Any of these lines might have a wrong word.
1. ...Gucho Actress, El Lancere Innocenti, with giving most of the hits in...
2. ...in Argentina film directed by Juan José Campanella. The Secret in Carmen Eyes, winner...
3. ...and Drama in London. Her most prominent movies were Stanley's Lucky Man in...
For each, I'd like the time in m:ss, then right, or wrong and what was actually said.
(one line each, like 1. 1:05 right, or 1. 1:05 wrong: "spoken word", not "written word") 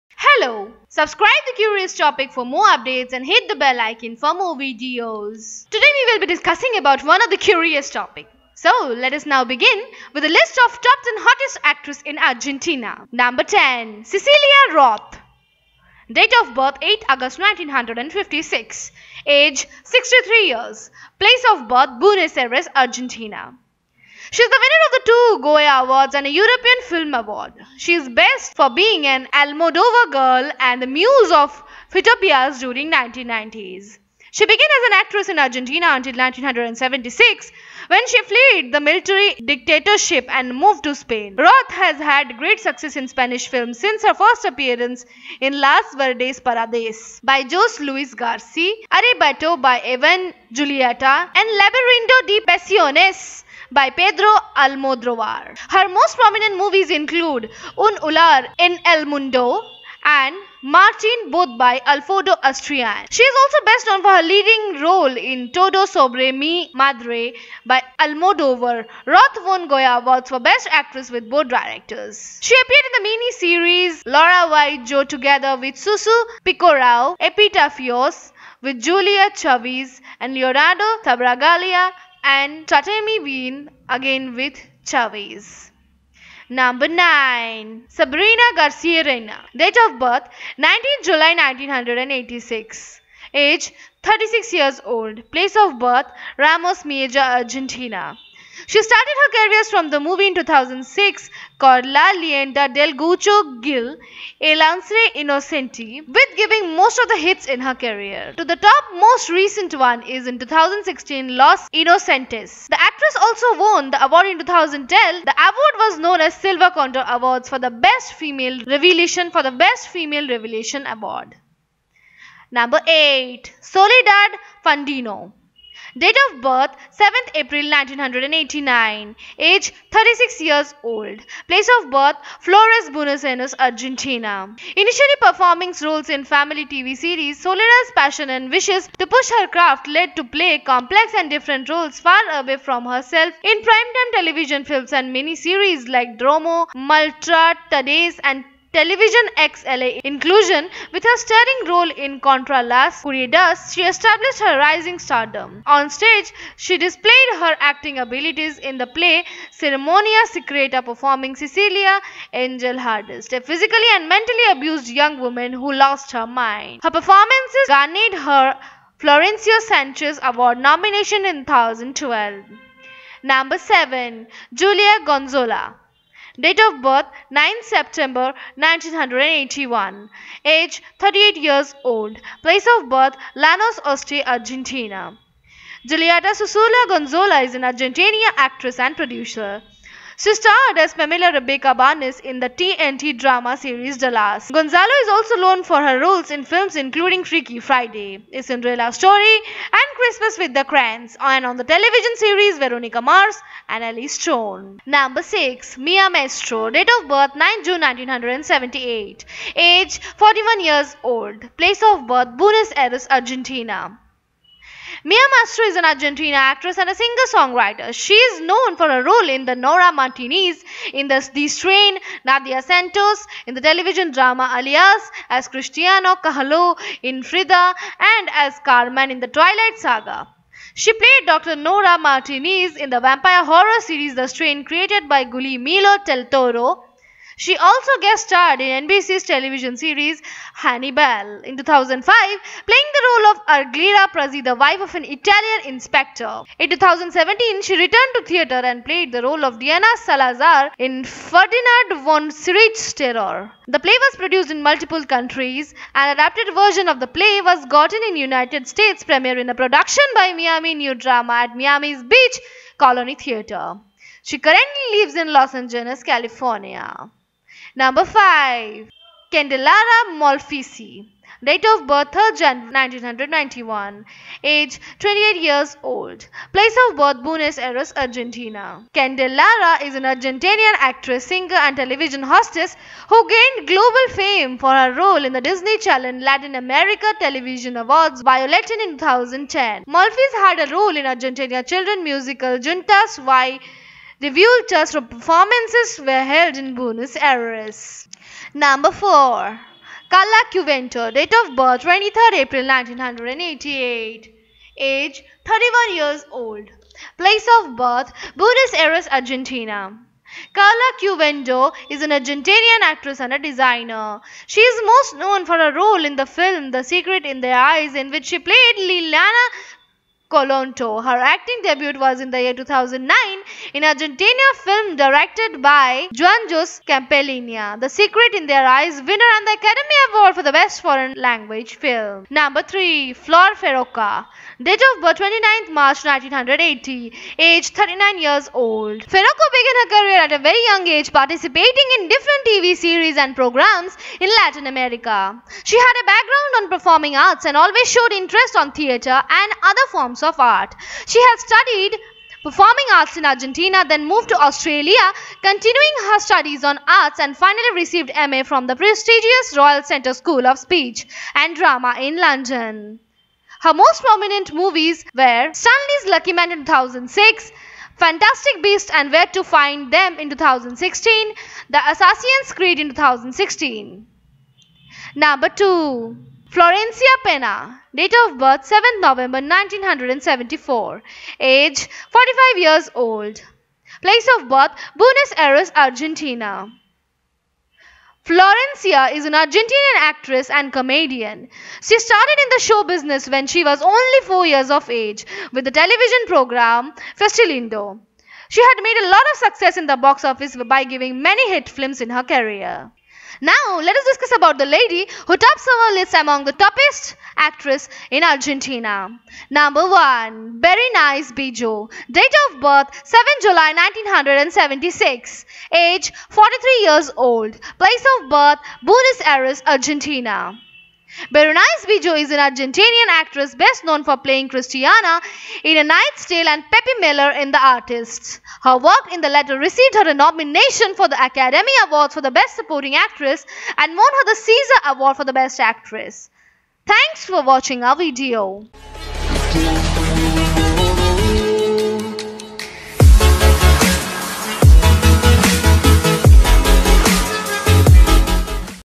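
1. 1:42 wrong: "Gil", not "Actress"
2. 5:23 wrong: "Their", not "Carmen"
3. 6:01 right.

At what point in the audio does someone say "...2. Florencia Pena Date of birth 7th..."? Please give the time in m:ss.
6:15.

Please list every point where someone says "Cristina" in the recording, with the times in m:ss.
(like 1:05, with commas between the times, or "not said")
3:45.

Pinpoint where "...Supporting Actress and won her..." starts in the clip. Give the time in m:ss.
7:12.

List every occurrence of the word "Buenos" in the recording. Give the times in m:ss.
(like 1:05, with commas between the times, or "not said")
0:22, 2:12, 3:32, 4:37, 4:56, 5:08, 6:24, 6:58.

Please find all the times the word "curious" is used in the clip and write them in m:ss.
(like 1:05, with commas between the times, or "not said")
0:01, 0:07.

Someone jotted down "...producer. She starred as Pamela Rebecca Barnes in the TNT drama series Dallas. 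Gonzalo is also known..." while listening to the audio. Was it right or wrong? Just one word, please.
right.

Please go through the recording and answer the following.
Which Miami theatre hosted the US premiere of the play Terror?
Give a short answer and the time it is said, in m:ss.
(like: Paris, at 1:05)
Colony Theatre, at 4:22.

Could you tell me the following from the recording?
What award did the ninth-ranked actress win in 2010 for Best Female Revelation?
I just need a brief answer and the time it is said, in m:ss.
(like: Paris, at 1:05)
Silver Condor Awards, at 1:56.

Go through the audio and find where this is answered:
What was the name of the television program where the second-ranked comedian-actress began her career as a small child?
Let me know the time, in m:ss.
6:37.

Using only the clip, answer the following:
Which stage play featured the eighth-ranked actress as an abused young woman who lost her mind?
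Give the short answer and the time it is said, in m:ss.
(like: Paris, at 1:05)
Ceremonia Secreta, at 2:39.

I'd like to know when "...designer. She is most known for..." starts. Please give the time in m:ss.
5:13.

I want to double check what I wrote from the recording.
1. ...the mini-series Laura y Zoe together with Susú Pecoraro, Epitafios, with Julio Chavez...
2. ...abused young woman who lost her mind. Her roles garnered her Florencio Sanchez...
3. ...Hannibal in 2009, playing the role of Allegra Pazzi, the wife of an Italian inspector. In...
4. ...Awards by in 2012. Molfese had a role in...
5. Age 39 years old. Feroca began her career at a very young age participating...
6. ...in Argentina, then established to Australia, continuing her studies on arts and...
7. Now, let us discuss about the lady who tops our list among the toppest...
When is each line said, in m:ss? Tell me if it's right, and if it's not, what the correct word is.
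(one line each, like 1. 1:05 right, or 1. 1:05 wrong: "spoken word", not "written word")
1. 1:12 right
2. 2:44 wrong: "performances", not "roles"
3. 4:00 wrong: "2005", not "2009"
4. 4:47 wrong: "2010", not "2012"
5. 5:37 right
6. 5:53 wrong: "moved", not "established"
7. 6:43 right.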